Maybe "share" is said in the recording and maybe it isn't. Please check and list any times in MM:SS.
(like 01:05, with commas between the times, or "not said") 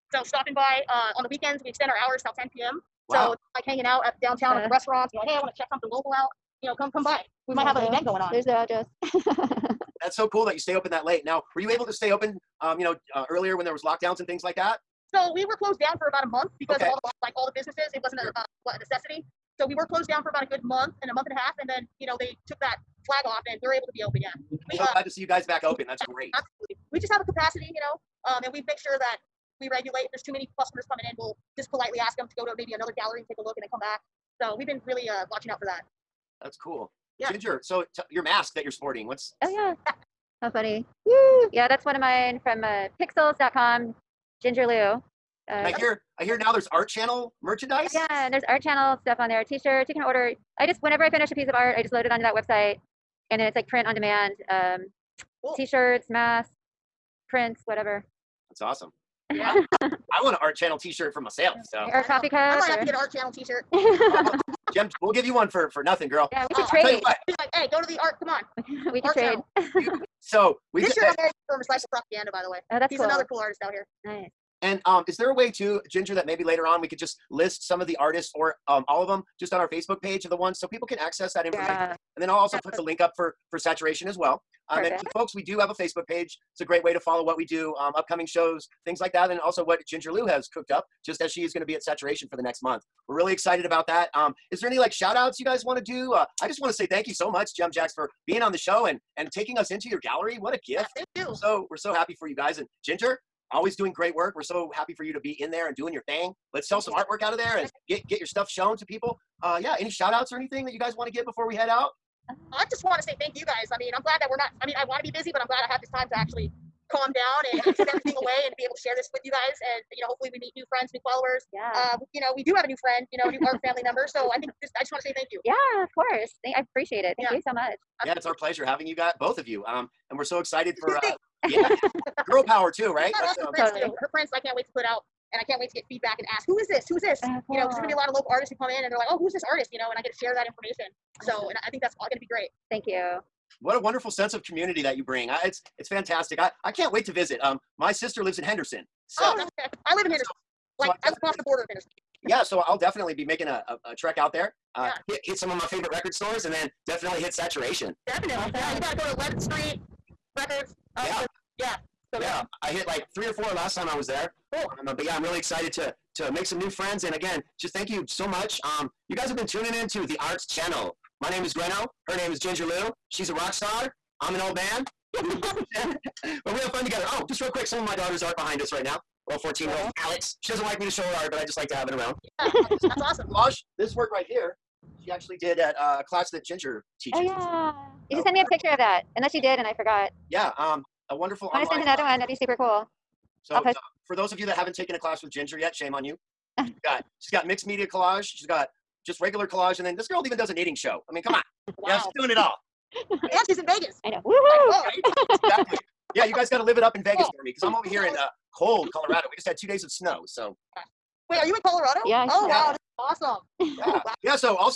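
01:58, 02:20.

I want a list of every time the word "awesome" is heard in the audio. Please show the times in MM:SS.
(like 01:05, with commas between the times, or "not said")
00:58, 02:38, 03:03, 03:32.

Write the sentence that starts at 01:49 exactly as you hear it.
Uh, yeah, any shout outs or anything that you guys want to get before we head out?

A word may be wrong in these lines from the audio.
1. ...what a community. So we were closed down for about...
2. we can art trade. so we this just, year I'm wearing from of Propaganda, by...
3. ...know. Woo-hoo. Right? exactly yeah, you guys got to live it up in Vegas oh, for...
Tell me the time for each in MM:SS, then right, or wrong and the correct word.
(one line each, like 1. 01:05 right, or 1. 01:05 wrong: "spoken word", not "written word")
1. 00:18 wrong: "necessity", not "community"
2. 01:08 right
3. 03:24 right.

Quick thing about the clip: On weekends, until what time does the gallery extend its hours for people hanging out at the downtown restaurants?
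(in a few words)
10 p.m.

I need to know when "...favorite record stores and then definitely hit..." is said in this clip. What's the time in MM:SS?
02:35.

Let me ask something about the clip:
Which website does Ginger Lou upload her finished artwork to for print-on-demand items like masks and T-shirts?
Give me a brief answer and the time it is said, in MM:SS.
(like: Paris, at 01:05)
Pixels.com, at 00:43.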